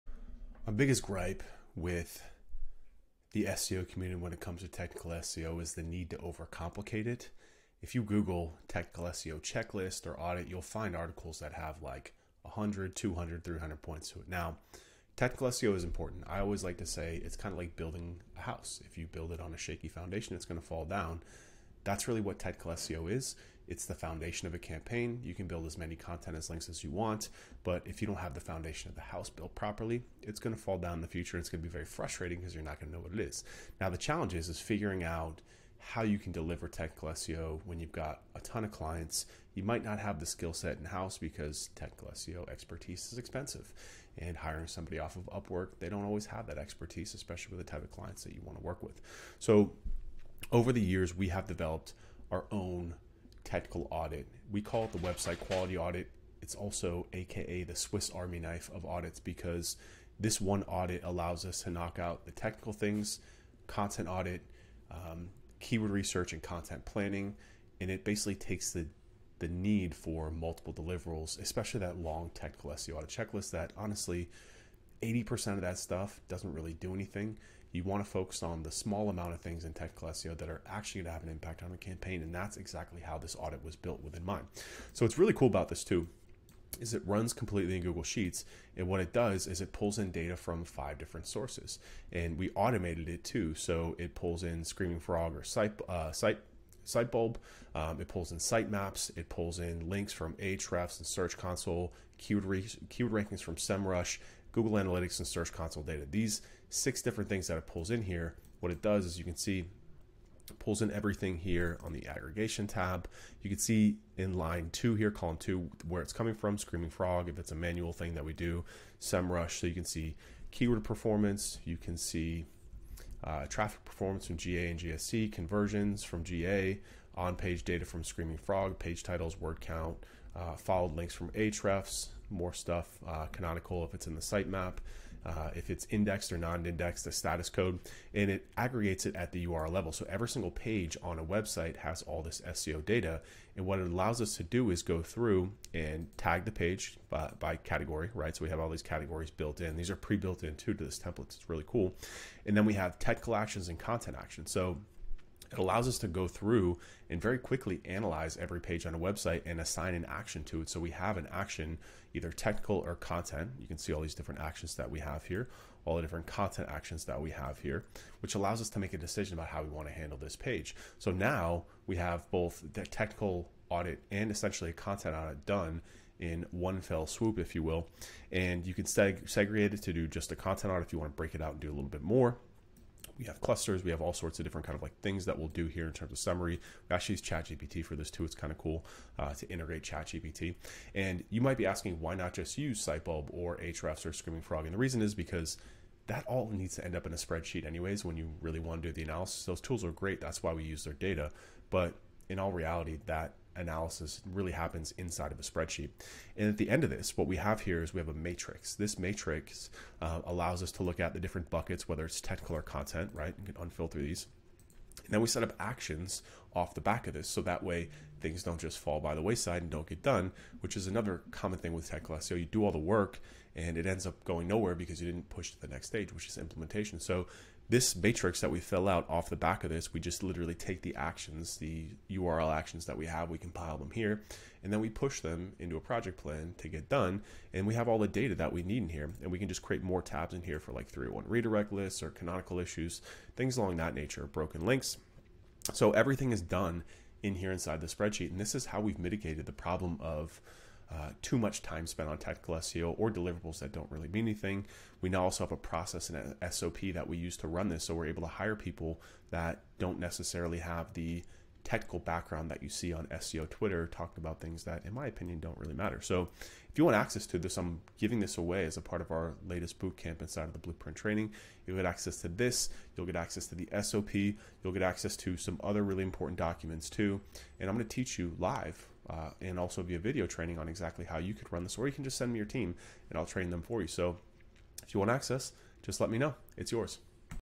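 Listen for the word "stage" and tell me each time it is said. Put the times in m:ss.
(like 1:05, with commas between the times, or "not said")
3:45.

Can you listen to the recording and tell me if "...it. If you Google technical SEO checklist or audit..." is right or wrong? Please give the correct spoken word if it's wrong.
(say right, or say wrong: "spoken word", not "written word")
right.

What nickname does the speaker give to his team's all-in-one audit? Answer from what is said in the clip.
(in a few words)
Swiss Army knife of audits.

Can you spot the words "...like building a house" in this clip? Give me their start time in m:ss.
0:17.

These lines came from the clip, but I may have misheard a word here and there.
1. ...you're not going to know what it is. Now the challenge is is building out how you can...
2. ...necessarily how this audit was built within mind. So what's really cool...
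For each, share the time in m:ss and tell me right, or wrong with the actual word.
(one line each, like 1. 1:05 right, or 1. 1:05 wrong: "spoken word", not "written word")
1. 0:32 wrong: "figuring", not "building"
2. 1:22 wrong: "exactly", not "necessarily".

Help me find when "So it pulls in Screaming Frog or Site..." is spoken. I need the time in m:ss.
1:33.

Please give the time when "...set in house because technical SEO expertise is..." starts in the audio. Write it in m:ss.
0:40.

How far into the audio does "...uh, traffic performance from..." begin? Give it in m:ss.
2:03.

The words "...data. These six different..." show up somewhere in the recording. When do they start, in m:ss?
1:45.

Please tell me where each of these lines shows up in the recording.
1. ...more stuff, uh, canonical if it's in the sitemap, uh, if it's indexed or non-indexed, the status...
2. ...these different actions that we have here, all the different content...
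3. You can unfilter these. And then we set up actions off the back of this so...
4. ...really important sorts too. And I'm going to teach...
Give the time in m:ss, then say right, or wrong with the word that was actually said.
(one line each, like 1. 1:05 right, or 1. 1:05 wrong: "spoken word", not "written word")
1. 2:12 right
2. 2:44 right
3. 3:33 right
4. 4:35 wrong: "documents", not "sorts".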